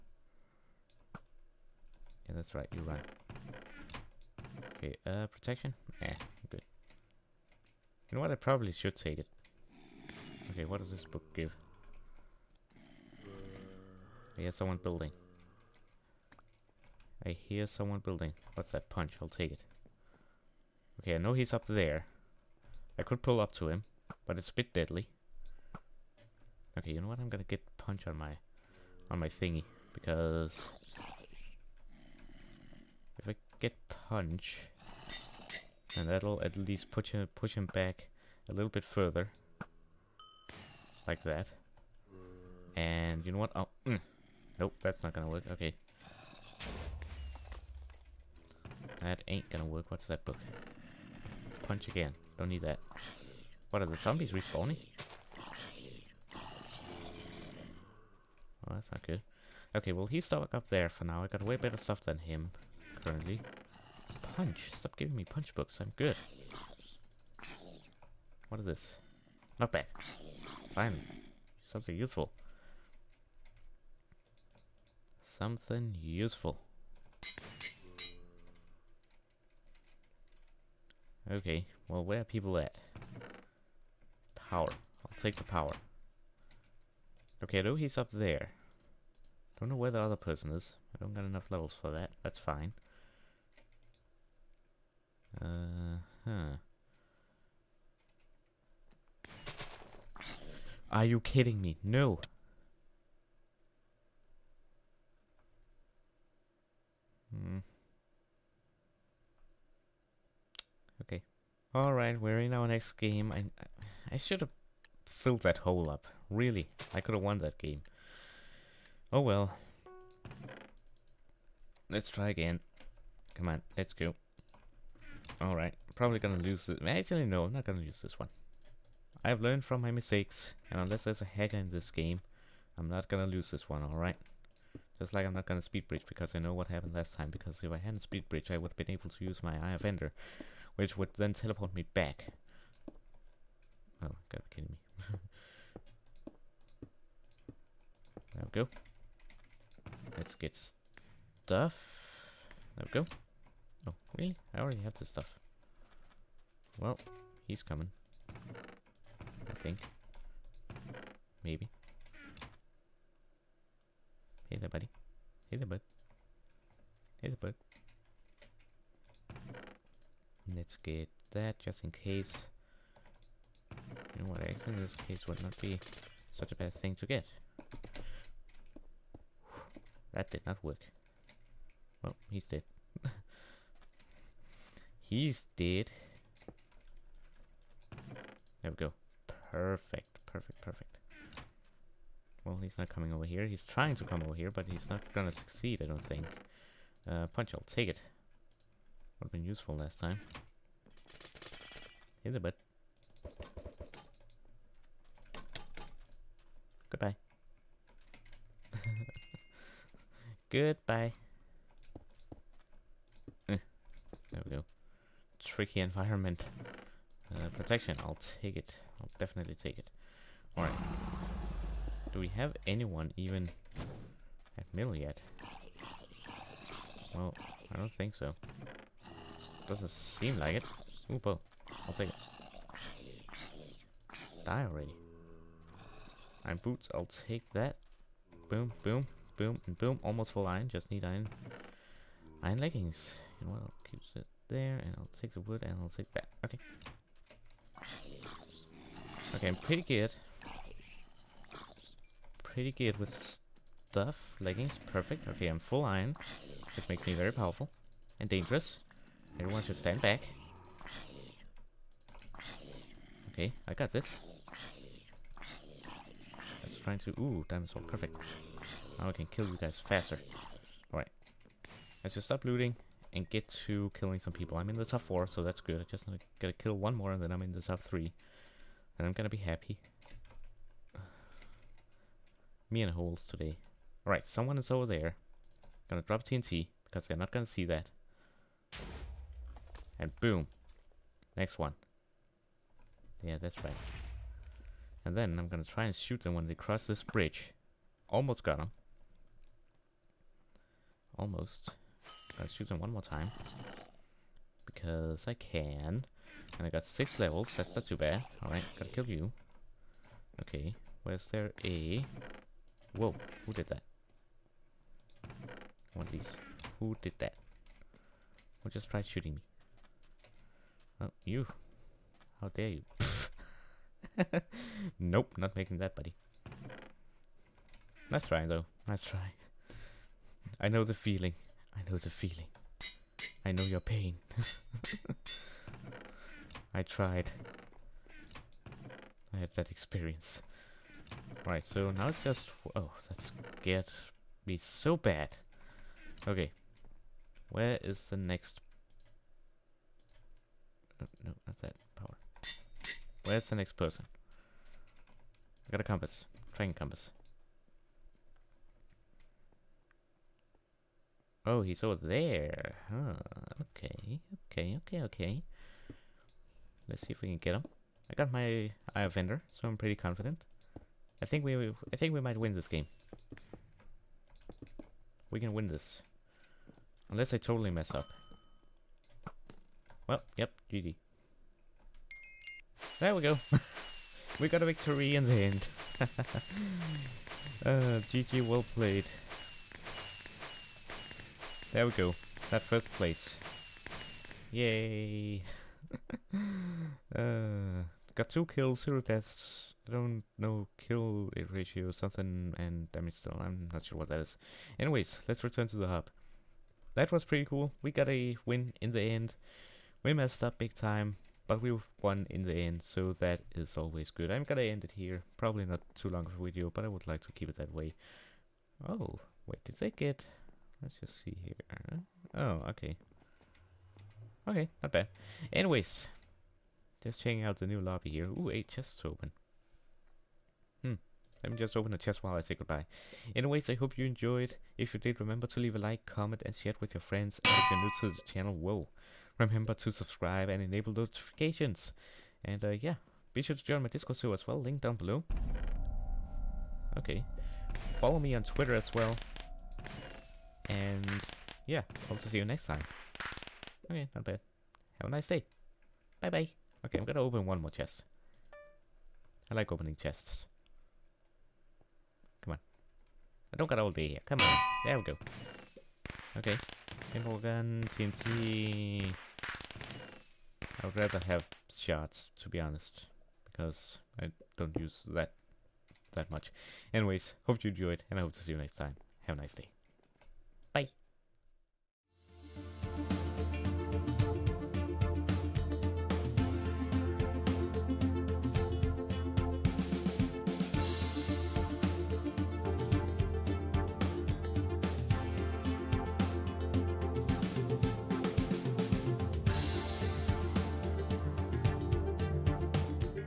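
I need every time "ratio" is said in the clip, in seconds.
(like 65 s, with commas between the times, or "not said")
401 s.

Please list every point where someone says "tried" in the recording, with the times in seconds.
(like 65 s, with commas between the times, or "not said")
318 s, 336 s.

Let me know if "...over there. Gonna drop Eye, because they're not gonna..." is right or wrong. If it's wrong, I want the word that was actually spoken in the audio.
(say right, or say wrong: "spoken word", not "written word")
wrong: "TNT", not "Eye".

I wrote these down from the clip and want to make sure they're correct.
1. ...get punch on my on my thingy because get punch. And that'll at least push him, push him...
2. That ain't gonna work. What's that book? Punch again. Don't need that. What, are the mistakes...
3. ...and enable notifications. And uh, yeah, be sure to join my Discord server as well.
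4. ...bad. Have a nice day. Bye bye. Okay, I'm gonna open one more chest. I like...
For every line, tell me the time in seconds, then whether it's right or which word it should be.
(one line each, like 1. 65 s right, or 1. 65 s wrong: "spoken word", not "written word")
1. 27 s right
2. 48 s wrong: "zombies", not "mistakes"
3. 440 s right
4. 454 s right.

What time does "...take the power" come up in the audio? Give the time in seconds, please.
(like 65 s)
85 s.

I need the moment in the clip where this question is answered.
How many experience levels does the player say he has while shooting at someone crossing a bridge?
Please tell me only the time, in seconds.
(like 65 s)
306 s.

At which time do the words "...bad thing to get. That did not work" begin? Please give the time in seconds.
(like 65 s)
176 s.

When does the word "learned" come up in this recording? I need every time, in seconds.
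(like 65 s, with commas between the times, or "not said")
129 s.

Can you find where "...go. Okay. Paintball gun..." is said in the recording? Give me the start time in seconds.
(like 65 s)
465 s.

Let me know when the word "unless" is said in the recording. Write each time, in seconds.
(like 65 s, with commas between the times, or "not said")
130 s, 377 s.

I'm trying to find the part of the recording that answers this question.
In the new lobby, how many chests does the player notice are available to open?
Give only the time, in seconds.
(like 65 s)
428 s.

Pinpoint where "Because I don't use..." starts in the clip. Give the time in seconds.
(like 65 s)
473 s.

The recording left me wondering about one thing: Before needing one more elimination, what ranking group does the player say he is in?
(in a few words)
top 4.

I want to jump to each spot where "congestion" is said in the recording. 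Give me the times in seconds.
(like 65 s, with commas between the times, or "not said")
not said.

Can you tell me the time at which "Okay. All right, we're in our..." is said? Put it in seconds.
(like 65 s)
111 s.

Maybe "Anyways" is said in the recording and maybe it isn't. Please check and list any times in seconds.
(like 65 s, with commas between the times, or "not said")
404 s, 425 s, 433 s, 476 s.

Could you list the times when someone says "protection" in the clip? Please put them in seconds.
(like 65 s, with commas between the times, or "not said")
5 s, 217 s.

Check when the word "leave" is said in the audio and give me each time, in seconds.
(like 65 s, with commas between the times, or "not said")
435 s.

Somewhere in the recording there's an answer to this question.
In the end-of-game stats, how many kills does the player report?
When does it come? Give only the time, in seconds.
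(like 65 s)
398 s.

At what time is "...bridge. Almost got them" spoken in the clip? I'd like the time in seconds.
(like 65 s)
297 s.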